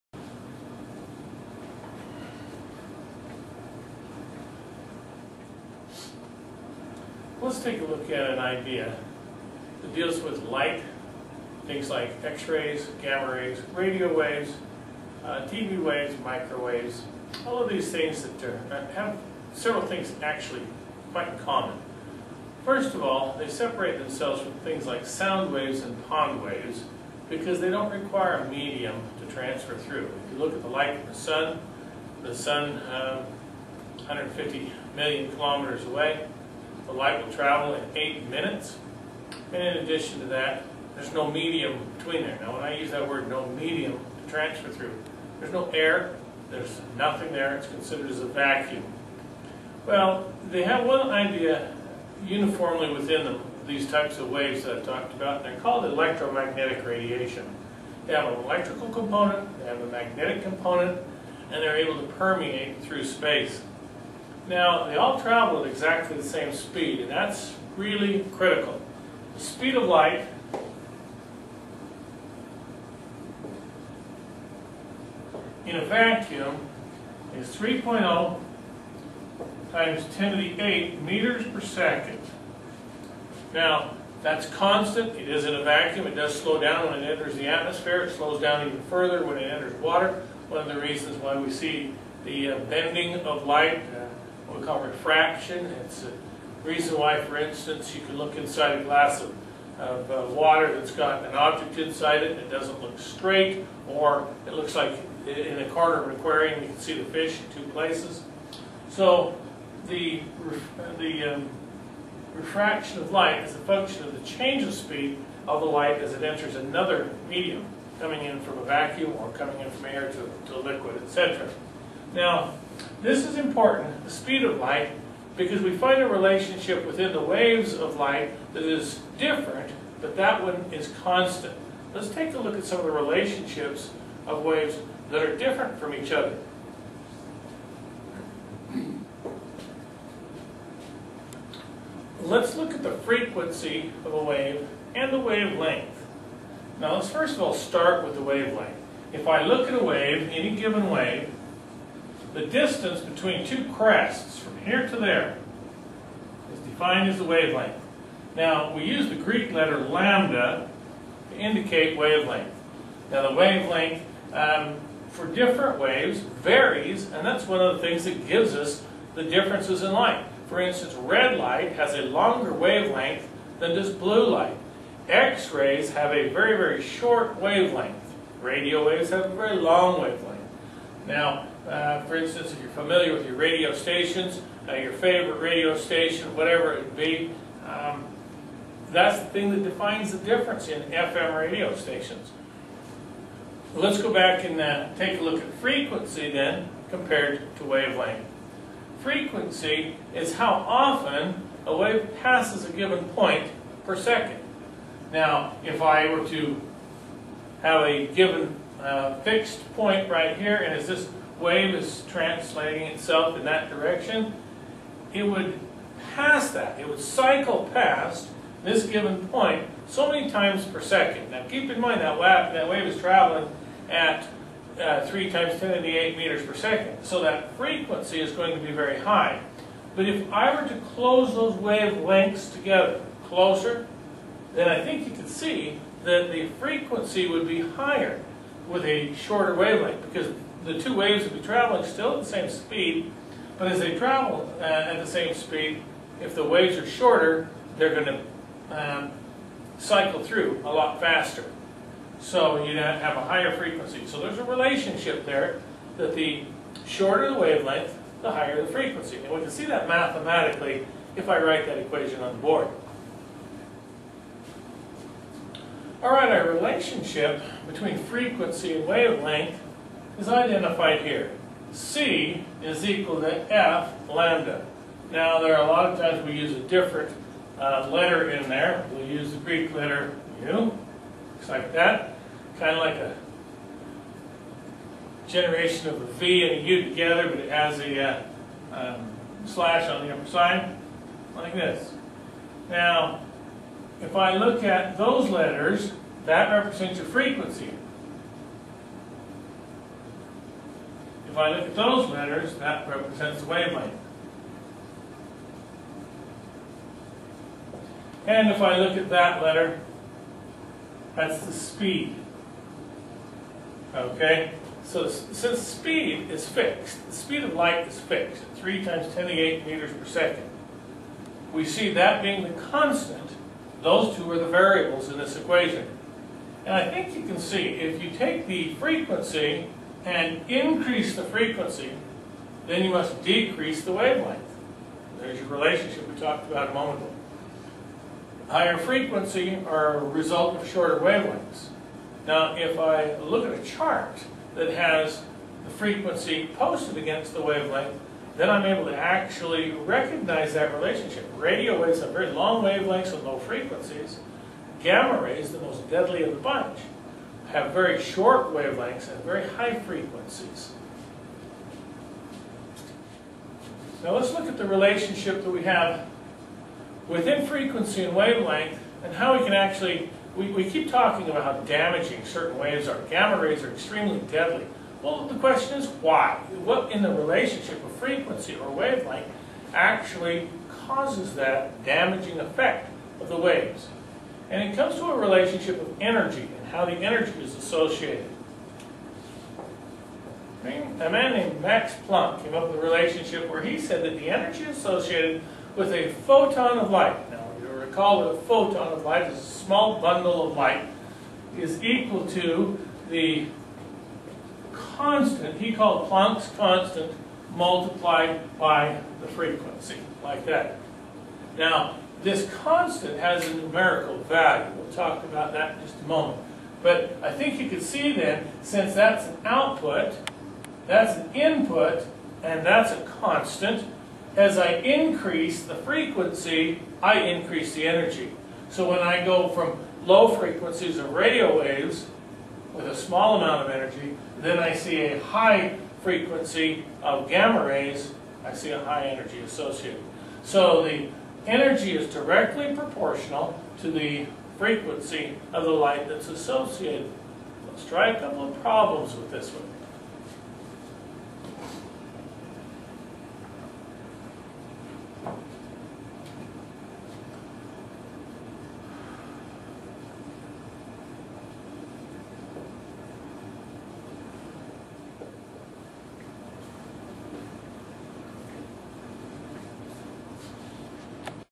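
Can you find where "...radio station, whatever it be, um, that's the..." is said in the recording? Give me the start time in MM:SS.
03:05.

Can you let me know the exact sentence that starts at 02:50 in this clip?
For instance, red light has a longer wavelength than does blue light.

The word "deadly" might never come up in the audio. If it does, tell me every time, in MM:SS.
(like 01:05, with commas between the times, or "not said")
05:55, 06:14.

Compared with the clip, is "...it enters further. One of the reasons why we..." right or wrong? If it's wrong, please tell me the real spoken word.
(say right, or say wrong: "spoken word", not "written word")
wrong: "water", not "further".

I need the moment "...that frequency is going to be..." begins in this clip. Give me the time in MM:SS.
03:47.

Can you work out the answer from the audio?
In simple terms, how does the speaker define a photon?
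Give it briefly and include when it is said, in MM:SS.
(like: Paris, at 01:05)
a small bundle of light, at 06:39.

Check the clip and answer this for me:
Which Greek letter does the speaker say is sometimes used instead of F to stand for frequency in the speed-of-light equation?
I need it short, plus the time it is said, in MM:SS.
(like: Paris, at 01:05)
mu, at 04:40.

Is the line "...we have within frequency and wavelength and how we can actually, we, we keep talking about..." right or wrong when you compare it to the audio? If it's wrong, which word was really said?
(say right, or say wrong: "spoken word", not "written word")
right.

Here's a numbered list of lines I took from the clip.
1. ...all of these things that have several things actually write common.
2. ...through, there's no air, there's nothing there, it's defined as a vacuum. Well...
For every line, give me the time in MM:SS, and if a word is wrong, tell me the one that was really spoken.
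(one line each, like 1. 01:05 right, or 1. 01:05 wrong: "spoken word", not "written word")
1. 00:17 wrong: "quite", not "write"
2. 00:44 wrong: "considered", not "defined".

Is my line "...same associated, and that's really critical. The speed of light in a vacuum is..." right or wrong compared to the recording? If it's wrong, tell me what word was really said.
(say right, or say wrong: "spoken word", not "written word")
wrong: "speed", not "associated".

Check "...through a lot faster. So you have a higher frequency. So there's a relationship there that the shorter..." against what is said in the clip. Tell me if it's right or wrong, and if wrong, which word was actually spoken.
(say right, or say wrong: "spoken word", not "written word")
right.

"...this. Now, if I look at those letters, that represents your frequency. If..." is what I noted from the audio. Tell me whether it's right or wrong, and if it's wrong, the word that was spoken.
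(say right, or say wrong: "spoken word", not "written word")
right.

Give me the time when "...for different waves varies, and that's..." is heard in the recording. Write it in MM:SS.
02:45.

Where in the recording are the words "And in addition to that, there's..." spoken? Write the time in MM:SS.
00:39.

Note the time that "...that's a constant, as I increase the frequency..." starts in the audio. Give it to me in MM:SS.
07:02.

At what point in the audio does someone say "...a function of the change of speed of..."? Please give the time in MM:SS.
01:53.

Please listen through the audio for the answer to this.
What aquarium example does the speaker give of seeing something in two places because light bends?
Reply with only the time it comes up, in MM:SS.
01:46.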